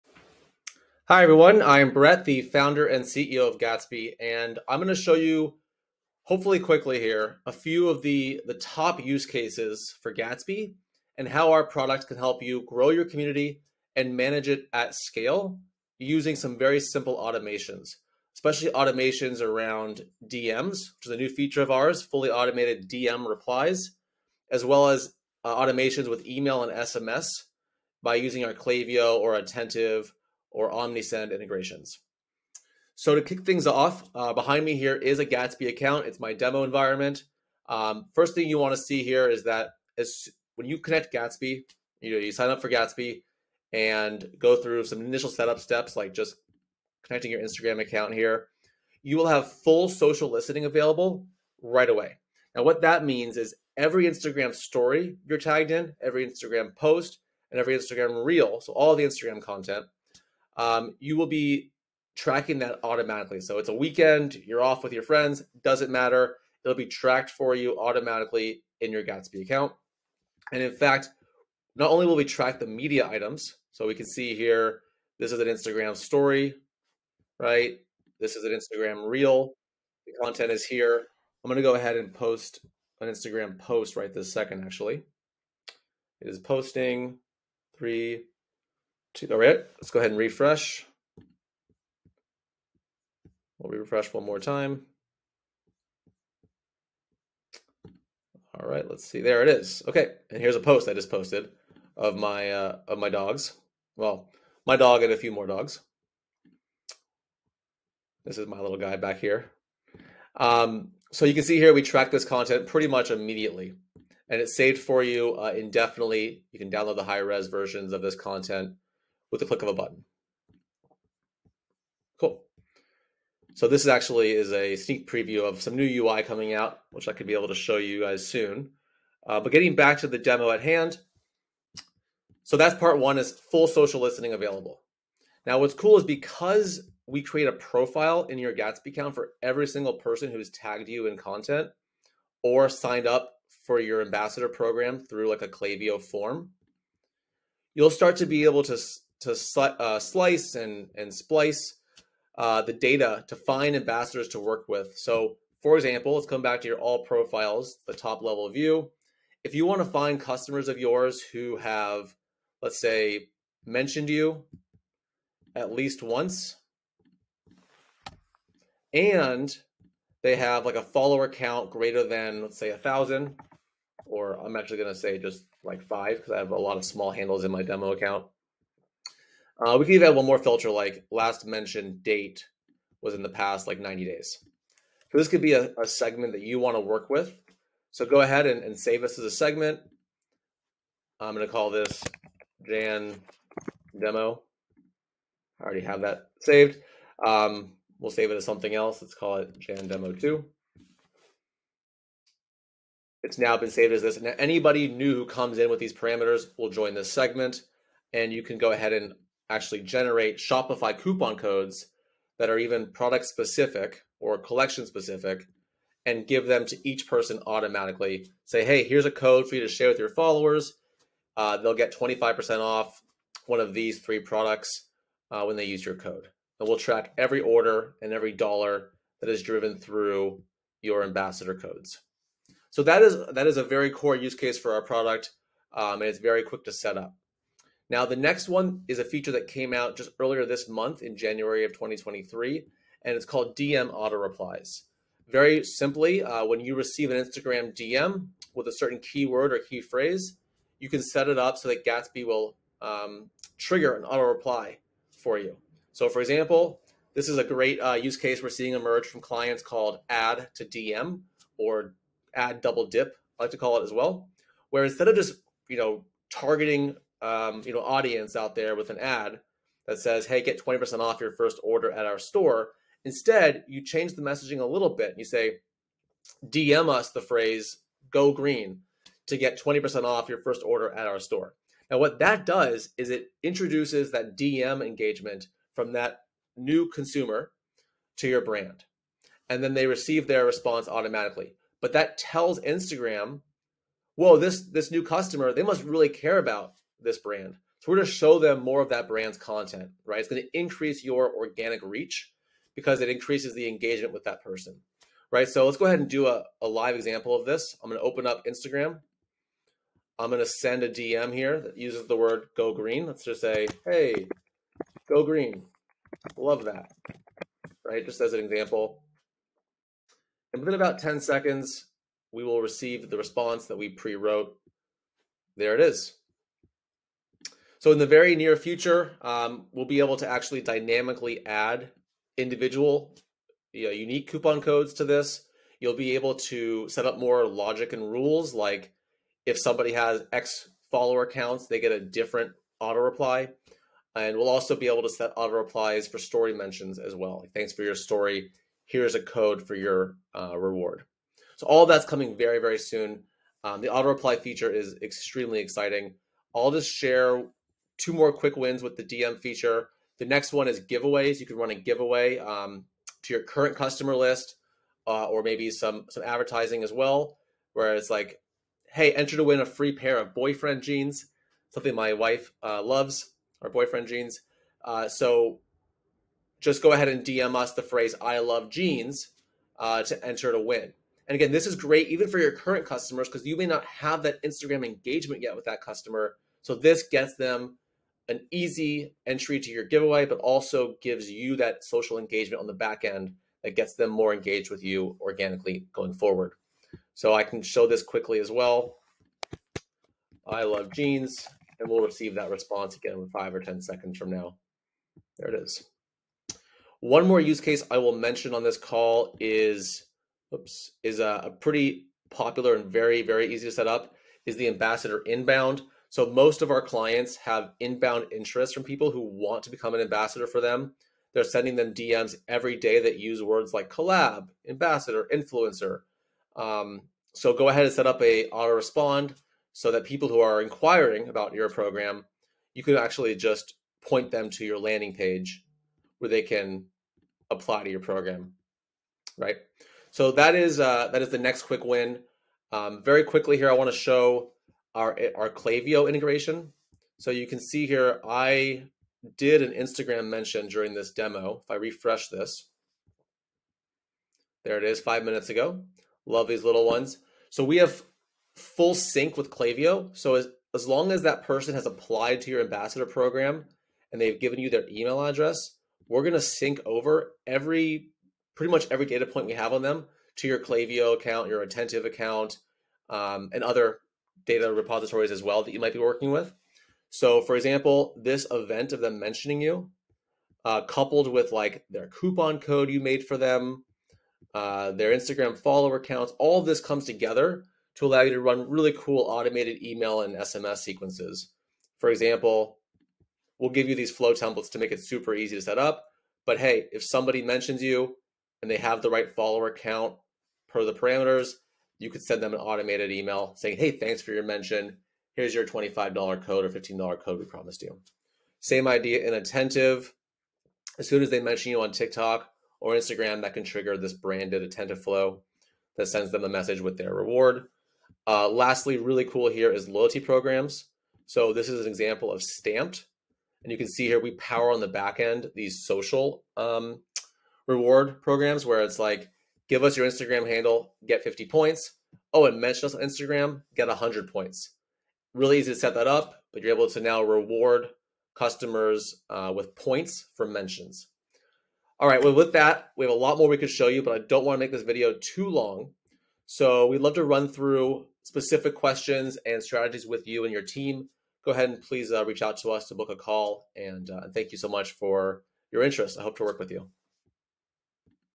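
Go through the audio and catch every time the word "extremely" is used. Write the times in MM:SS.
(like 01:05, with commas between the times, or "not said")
05:55.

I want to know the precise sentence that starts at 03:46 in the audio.
And we'll track every order and every dollar that is driven through your ambassador codes.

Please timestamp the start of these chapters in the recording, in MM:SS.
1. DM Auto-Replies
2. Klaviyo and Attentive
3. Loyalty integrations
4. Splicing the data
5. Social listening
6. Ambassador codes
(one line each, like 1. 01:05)
1. 03:55
2. 07:23
3. 08:38
4. 02:13
5. 00:30
6. 03:28.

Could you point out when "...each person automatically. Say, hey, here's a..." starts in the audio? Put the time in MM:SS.
03:36.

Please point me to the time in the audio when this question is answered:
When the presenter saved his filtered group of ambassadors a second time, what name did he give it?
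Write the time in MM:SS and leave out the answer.
03:19.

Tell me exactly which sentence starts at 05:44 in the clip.
And we'll also be able to set auto replies for story mentions as well.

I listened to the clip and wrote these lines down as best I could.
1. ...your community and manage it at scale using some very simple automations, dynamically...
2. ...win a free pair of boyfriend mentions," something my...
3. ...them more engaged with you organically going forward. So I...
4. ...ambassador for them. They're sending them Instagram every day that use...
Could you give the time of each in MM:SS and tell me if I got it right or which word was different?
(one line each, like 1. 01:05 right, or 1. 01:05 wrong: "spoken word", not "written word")
1. 00:12 wrong: "especially", not "dynamically"
2. 06:09 wrong: "jeans", not "mentions"
3. 06:33 right
4. 07:00 wrong: "DMs", not "Instagram".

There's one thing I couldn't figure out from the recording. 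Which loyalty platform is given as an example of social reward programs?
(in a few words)
Stamped.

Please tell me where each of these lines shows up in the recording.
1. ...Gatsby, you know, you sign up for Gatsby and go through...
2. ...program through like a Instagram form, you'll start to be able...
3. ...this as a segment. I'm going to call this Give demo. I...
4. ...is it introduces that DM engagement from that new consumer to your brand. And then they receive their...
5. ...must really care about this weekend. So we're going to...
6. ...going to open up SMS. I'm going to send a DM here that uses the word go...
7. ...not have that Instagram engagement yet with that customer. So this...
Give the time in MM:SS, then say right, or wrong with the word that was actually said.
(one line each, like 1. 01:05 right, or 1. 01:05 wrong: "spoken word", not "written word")
1. 00:41 right
2. 02:24 wrong: "Klaviyo", not "Instagram"
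3. 03:09 wrong: "Jan", not "Give"
4. 04:42 right
5. 04:55 wrong: "brand", not "weekend"
6. 05:07 wrong: "Instagram", not "SMS"
7. 06:23 right.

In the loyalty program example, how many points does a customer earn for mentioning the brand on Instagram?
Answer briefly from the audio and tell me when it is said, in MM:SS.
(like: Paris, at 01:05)
100, at 08:53.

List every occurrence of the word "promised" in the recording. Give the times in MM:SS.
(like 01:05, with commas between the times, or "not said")
08:27.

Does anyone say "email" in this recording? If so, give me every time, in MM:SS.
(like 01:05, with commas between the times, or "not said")
00:26, 07:44, 08:09, 08:23.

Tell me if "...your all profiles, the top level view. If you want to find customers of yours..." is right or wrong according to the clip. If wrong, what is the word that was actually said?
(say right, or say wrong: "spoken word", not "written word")
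right.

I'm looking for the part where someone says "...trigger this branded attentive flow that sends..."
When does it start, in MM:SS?
08:33.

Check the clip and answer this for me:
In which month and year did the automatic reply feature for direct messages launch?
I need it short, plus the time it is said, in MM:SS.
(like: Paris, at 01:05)
January 2023, at 04:01.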